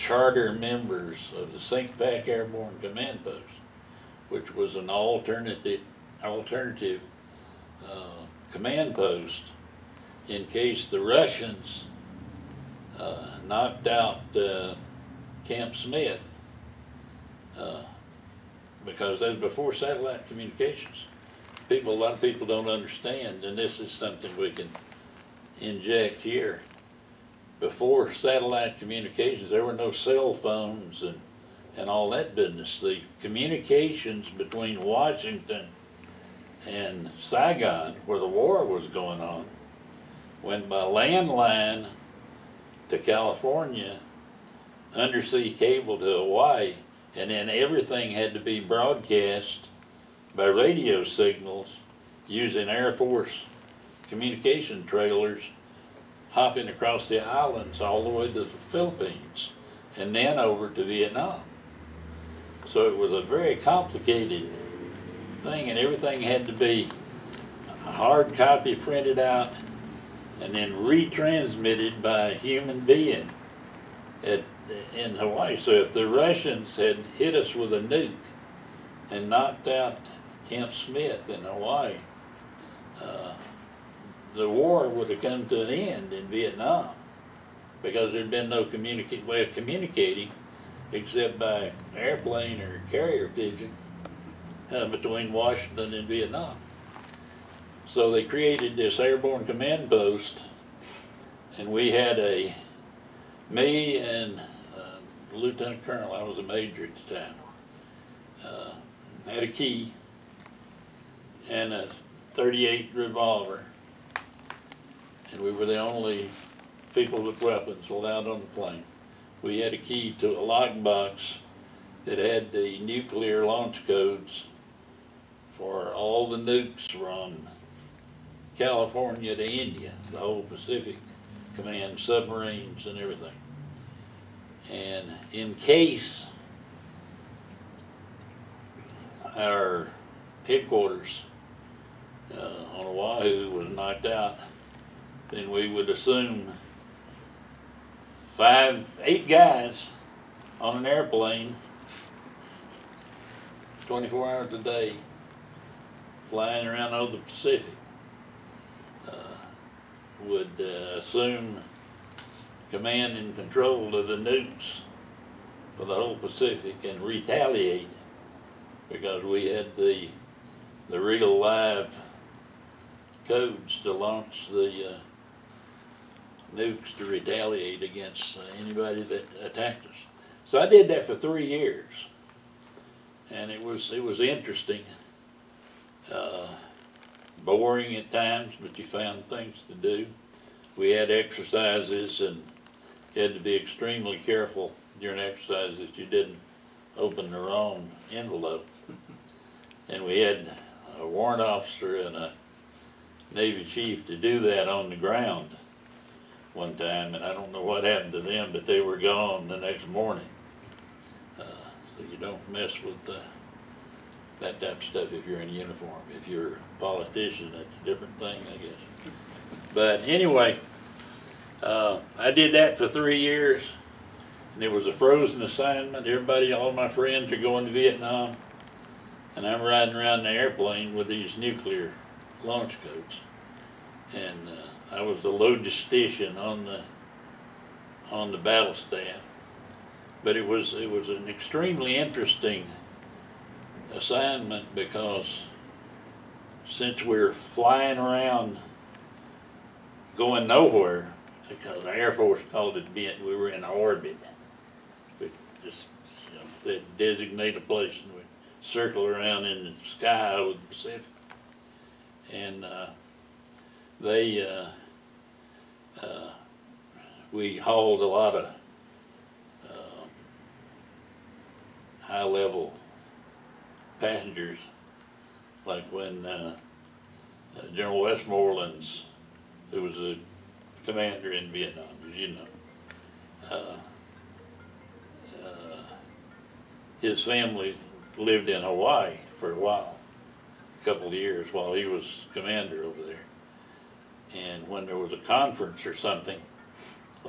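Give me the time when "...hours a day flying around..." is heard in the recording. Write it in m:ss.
2:34.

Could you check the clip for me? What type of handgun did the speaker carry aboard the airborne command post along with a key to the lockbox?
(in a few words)
.38 revolver.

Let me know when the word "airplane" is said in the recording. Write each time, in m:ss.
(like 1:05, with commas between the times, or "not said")
1:31, 2:30, 3:50.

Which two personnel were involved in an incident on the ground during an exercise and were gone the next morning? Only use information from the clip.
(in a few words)
A warrant officer and a Navy chief.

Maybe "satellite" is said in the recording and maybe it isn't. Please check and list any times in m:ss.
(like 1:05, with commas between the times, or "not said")
0:19, 0:28.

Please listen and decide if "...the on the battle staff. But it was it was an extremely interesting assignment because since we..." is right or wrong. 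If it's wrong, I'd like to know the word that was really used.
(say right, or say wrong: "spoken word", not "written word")
right.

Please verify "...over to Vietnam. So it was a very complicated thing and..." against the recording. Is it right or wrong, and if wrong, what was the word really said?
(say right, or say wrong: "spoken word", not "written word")
right.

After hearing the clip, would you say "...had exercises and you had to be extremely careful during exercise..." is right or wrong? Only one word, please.
right.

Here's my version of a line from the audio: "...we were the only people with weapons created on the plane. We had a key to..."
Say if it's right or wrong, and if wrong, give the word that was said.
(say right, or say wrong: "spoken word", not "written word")
wrong: "allowed", not "created".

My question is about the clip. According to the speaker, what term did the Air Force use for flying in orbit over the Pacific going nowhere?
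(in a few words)
Bent.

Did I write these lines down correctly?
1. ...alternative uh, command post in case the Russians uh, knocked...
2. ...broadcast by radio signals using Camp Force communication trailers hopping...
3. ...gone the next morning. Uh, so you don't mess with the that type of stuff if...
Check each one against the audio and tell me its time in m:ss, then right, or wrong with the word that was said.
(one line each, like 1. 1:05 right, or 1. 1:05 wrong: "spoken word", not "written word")
1. 0:06 right
2. 0:48 wrong: "Air", not "Camp"
3. 3:28 right.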